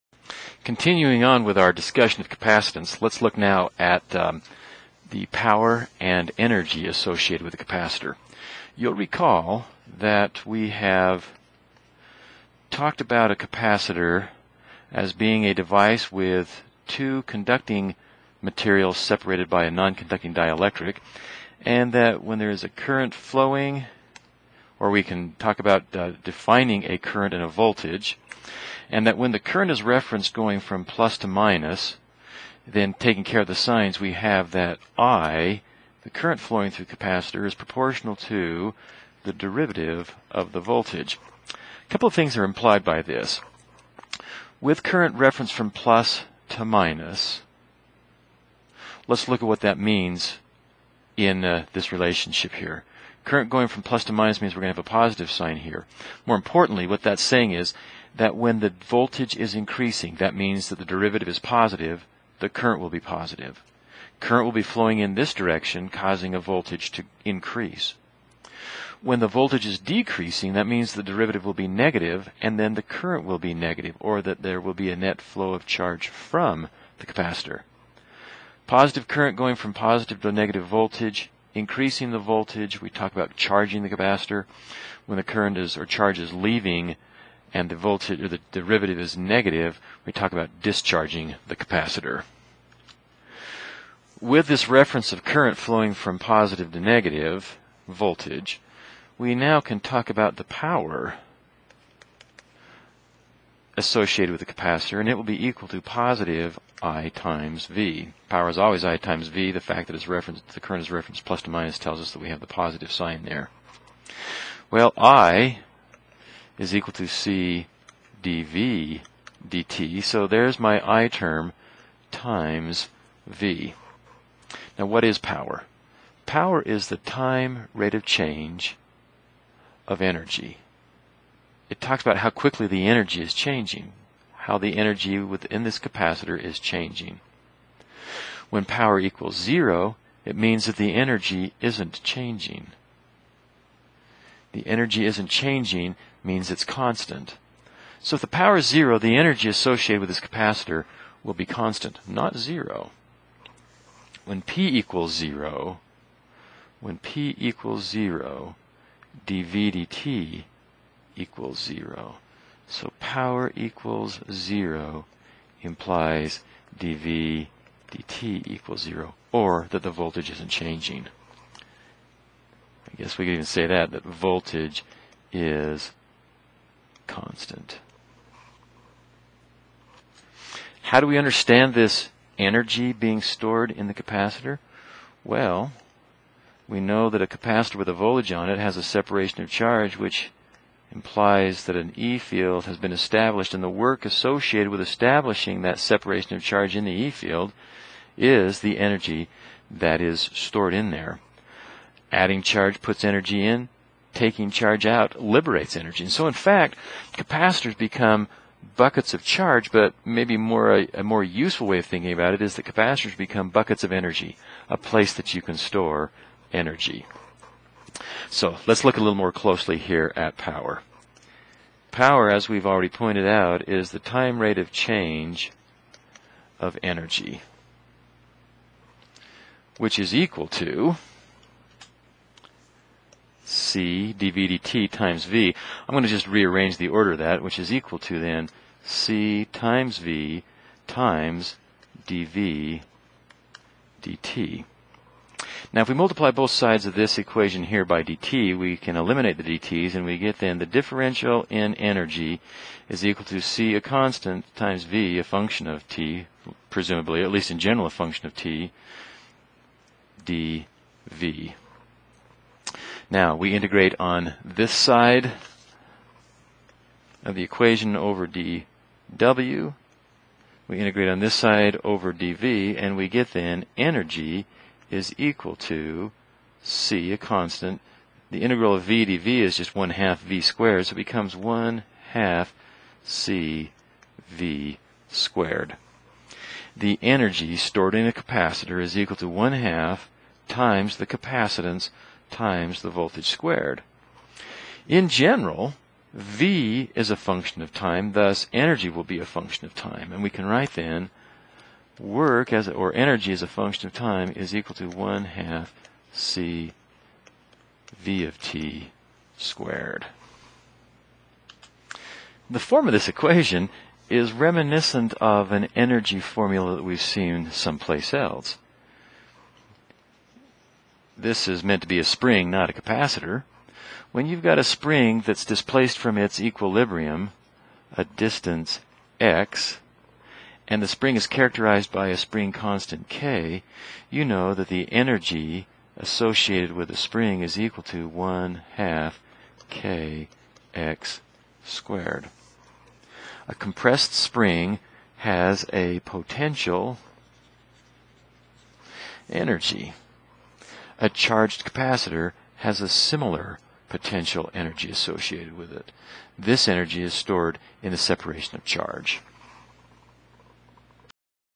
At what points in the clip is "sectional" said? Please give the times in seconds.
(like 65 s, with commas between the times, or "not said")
not said.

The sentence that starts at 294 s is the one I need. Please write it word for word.
In general, v is a function of time, thus energy will be a function of time.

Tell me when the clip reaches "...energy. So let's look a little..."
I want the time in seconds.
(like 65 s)
216 s.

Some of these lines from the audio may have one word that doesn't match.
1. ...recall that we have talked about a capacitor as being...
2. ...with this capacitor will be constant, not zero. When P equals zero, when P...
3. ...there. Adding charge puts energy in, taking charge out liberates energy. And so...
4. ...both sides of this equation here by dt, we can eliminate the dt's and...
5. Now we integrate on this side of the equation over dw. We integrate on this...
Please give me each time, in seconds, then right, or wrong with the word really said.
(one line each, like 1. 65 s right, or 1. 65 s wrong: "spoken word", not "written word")
1. 8 s right
2. 150 s right
3. 200 s right
4. 246 s right
5. 263 s right.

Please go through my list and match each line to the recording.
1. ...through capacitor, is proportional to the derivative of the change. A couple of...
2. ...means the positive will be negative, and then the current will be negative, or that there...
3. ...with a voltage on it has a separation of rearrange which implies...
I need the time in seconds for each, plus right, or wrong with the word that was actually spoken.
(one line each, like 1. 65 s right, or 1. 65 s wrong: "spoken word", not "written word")
1. 36 s wrong: "voltage", not "change"
2. 70 s wrong: "derivative", not "positive"
3. 187 s wrong: "charge", not "rearrange".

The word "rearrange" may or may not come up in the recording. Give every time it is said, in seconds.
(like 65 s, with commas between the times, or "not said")
236 s.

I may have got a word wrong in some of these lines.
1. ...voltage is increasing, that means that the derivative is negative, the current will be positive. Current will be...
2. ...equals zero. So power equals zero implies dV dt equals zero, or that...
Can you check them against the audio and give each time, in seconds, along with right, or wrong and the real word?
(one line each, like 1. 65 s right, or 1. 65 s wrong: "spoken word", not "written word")
1. 58 s wrong: "positive", not "negative"
2. 161 s right.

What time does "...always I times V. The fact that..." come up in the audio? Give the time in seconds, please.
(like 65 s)
108 s.